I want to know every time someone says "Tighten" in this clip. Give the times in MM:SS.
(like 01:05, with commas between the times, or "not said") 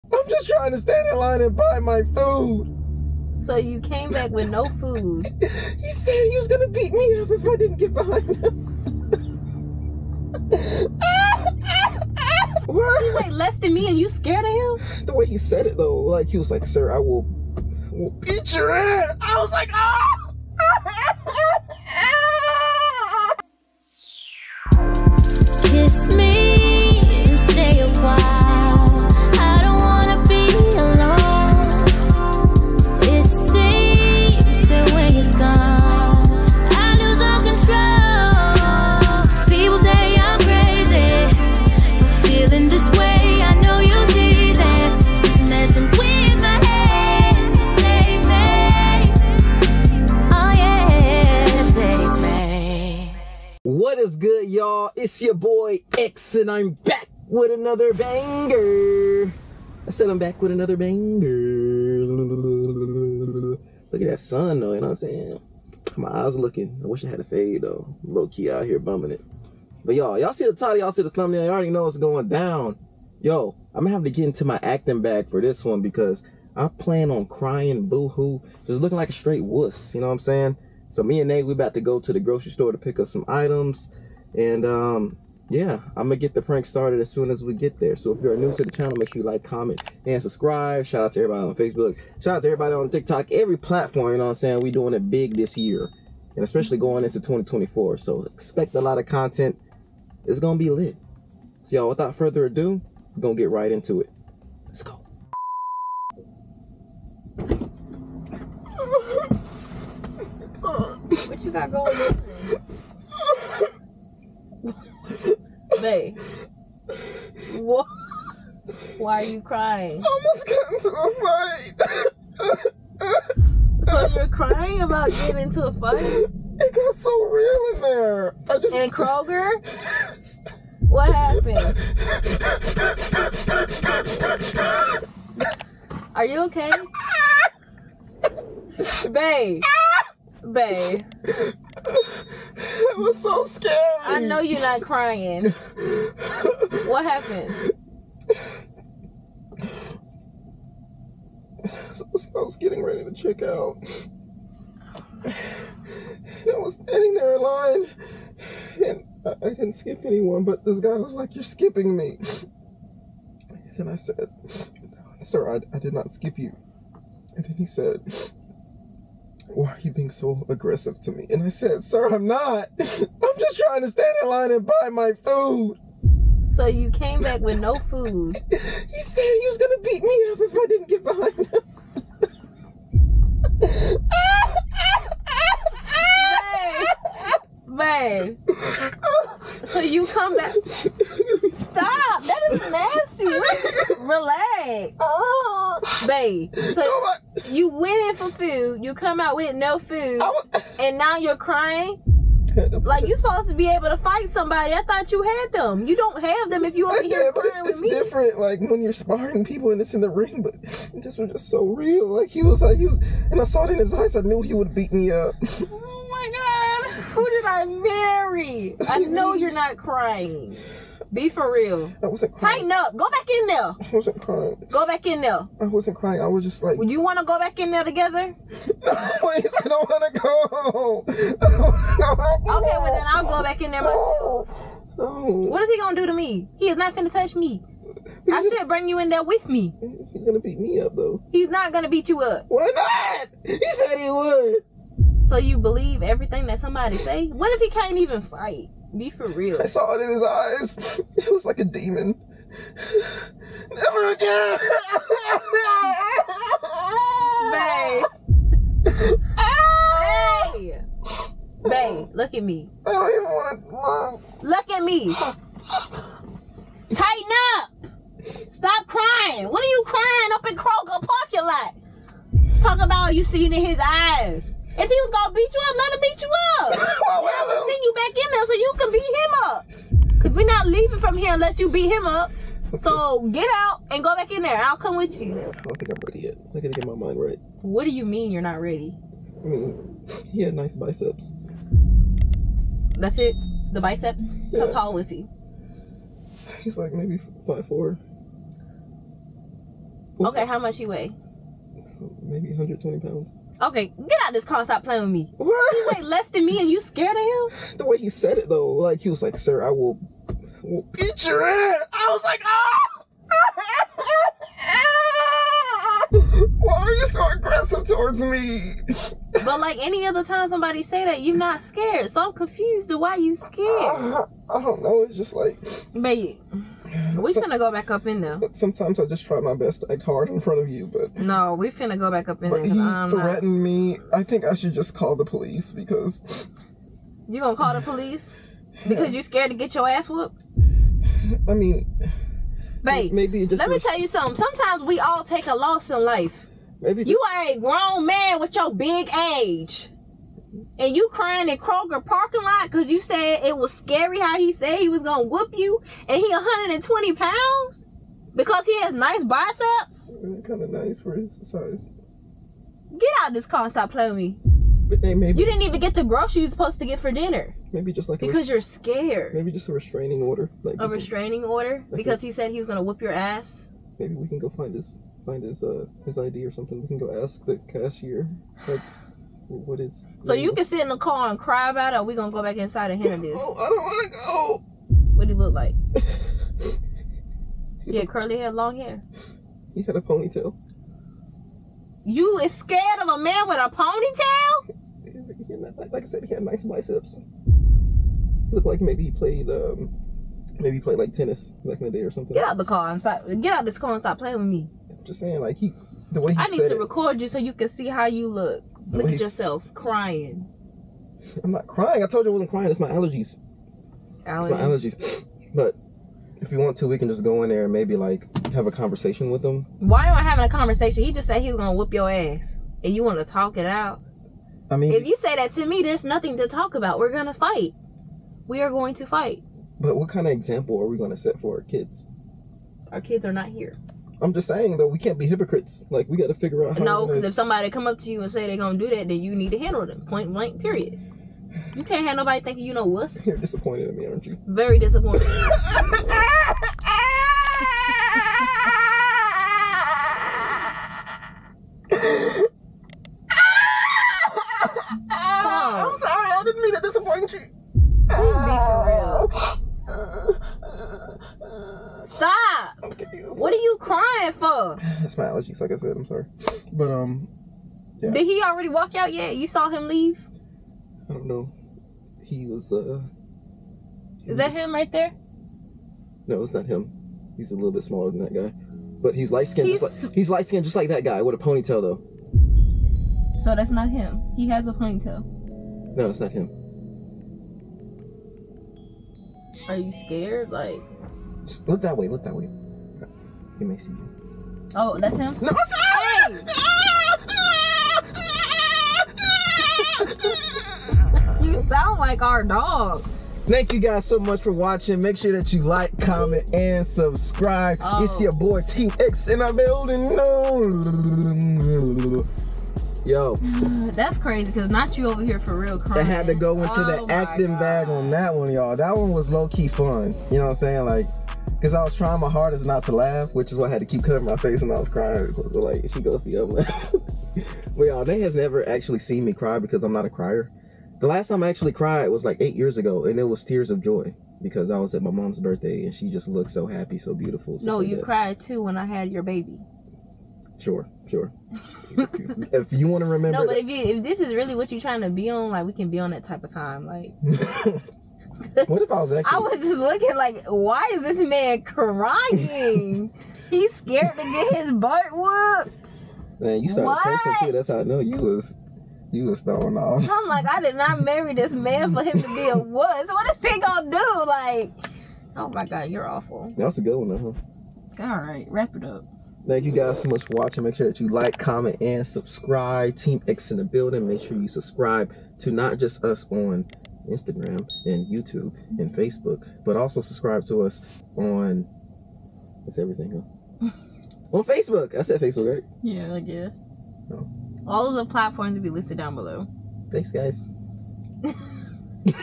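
03:42, 04:26.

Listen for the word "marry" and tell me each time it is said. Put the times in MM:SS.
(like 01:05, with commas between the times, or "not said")
03:37, 09:21.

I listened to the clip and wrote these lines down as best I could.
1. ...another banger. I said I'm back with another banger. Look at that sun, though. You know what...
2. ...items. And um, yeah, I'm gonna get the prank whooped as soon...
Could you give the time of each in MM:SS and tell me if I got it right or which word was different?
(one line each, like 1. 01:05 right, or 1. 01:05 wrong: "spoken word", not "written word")
1. 00:57 right
2. 01:23 wrong: "started", not "whooped".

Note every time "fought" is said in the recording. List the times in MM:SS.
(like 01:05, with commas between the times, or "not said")
not said.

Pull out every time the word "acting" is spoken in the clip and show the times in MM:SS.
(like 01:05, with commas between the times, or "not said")
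01:14, 08:37, 09:09.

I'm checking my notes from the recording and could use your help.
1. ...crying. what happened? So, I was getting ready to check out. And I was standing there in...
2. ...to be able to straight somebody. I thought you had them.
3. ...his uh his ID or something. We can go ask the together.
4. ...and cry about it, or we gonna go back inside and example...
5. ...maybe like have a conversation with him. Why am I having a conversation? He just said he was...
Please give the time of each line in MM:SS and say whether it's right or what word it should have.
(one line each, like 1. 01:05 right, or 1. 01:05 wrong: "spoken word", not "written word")
1. 02:24 right
2. 03:23 wrong: "fight", not "straight"
3. 06:15 wrong: "cashier", not "together"
4. 06:21 wrong: "handle", not "example"
5. 06:57 right.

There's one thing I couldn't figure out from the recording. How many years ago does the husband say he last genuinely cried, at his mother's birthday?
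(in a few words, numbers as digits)
8.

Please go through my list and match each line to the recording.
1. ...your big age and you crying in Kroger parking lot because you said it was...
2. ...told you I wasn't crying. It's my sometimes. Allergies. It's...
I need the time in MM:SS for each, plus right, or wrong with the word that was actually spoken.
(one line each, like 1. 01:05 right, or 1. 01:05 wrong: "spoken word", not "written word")
1. 05:48 right
2. 06:52 wrong: "allergies", not "sometimes".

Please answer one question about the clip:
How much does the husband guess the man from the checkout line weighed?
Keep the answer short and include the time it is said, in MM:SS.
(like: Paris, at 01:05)
120 pounds, at 05:02.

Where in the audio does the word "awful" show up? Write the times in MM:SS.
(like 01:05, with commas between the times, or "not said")
09:26.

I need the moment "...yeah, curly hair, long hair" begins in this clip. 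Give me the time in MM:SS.
06:27.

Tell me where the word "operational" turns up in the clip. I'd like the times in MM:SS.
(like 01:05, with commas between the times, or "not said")
not said.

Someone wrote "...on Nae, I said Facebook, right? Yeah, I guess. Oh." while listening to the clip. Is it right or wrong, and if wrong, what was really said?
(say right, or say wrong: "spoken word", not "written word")
wrong: "Facebook", not "Nae".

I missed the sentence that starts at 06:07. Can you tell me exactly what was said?
Maybe just like because you're scared.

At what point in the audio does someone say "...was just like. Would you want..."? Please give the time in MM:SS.
03:46.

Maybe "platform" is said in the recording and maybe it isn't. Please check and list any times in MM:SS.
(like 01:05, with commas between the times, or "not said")
01:33, 09:48.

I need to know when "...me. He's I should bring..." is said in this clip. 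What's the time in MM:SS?
03:57.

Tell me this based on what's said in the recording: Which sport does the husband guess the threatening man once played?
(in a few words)
Tennis.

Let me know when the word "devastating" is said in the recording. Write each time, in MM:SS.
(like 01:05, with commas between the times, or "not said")
not said.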